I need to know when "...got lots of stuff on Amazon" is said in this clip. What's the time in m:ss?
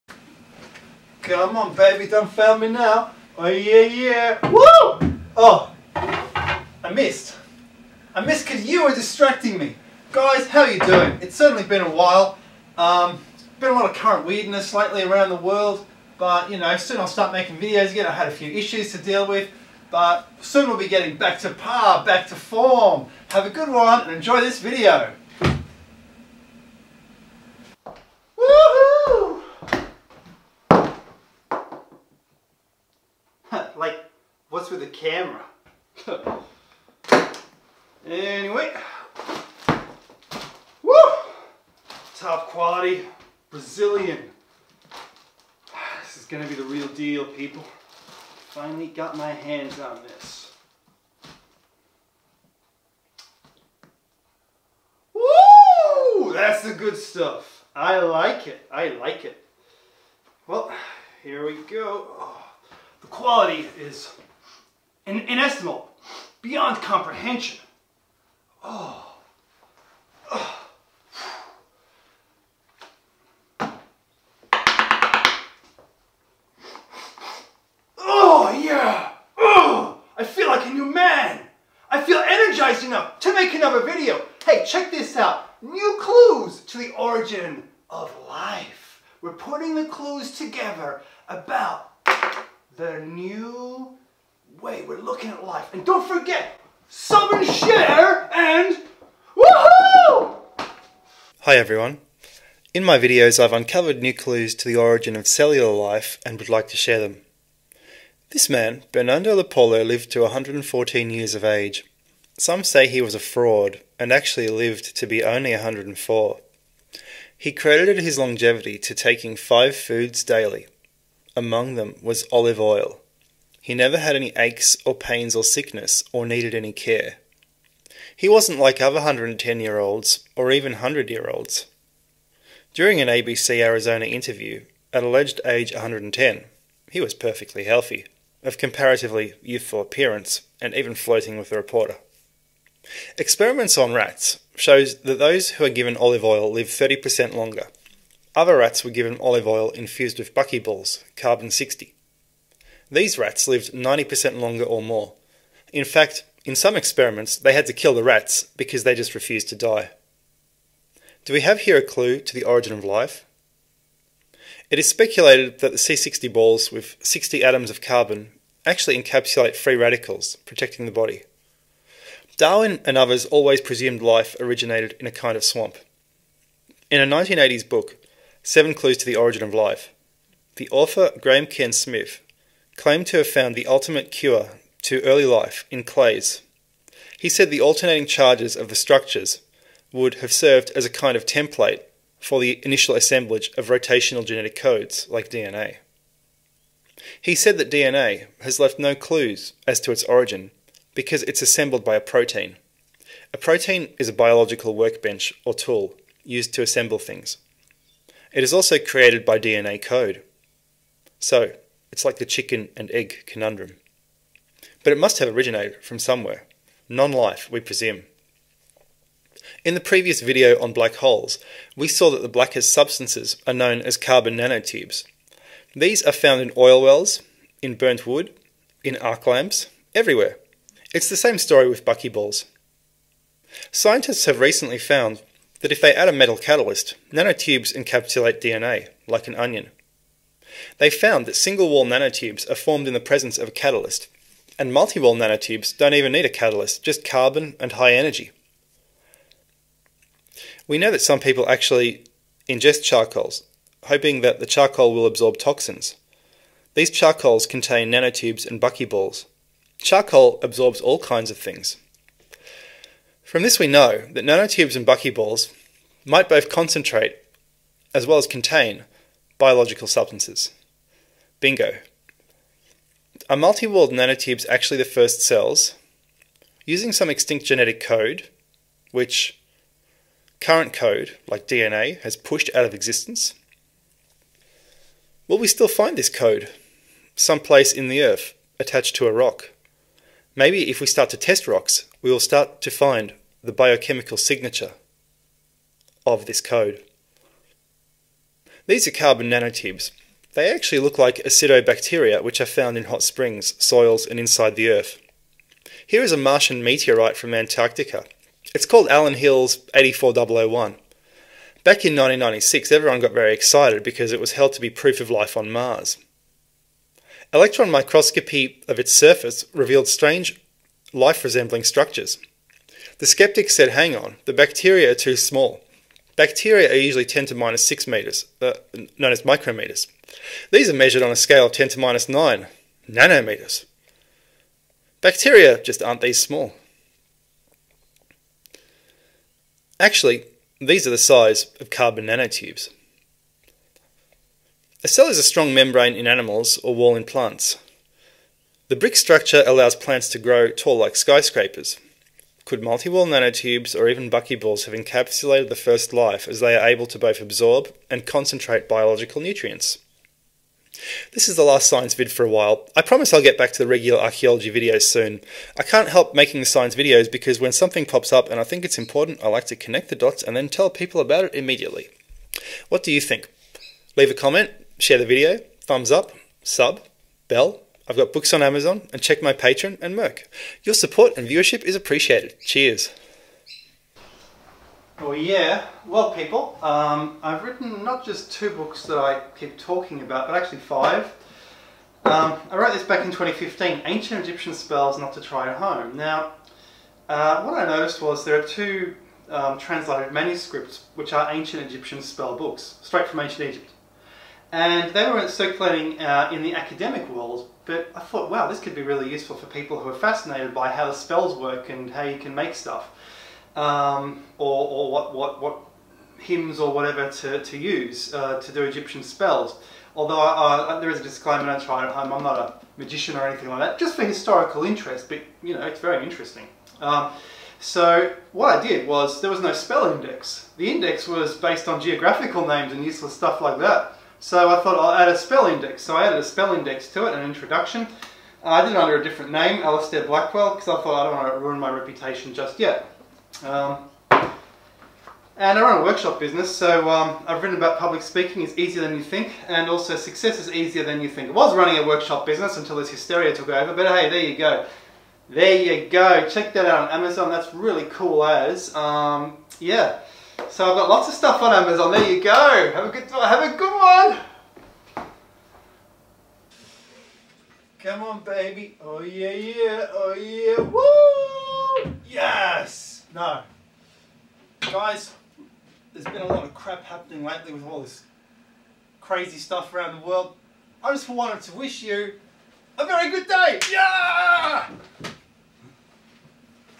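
7:40.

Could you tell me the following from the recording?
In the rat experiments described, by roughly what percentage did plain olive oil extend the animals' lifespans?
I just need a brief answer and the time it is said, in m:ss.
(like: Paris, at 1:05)
30%, at 2:26.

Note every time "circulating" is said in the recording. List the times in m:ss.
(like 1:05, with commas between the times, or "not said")
6:45.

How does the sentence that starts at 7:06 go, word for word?
Um, so what I did was, there was no spell index.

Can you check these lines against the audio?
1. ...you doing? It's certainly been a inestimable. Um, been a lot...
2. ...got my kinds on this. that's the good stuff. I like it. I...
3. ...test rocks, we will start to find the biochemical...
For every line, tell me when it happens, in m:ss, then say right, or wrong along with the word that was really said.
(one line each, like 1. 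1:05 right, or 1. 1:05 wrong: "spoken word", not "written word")
1. 0:10 wrong: "while", not "inestimable"
2. 0:48 wrong: "hands", not "kinds"
3. 4:51 right.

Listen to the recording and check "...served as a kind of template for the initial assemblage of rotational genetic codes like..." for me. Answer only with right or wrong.
right.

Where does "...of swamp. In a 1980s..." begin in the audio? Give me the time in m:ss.
2:55.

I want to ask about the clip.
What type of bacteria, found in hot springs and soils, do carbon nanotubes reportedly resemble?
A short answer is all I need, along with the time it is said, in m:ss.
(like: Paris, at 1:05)
acidobacteria, at 5:01.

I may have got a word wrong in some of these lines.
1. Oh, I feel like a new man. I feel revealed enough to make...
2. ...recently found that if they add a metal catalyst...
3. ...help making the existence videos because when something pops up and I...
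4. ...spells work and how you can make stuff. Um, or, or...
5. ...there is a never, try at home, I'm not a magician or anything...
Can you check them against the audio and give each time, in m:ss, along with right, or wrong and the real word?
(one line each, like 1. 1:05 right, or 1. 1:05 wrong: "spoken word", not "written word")
1. 1:19 wrong: "energized", not "revealed"
2. 3:54 right
3. 6:05 wrong: "science", not "existence"
4. 6:50 right
5. 7:00 wrong: "disclaimer", not "never".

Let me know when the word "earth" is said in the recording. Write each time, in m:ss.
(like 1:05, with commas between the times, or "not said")
4:48, 5:04.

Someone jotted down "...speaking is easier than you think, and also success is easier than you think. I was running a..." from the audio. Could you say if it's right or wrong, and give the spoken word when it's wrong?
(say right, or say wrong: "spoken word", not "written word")
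right.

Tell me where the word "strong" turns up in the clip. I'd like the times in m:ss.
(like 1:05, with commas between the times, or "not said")
5:45.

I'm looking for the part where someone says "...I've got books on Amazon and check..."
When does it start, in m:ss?
6:17.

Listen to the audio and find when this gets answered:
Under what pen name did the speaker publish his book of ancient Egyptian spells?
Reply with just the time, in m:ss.
7:19.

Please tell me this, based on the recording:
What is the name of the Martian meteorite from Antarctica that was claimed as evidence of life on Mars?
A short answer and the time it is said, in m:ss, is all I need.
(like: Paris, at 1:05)
Allan Hills 84001, at 5:08.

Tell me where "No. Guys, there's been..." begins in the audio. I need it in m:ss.
7:53.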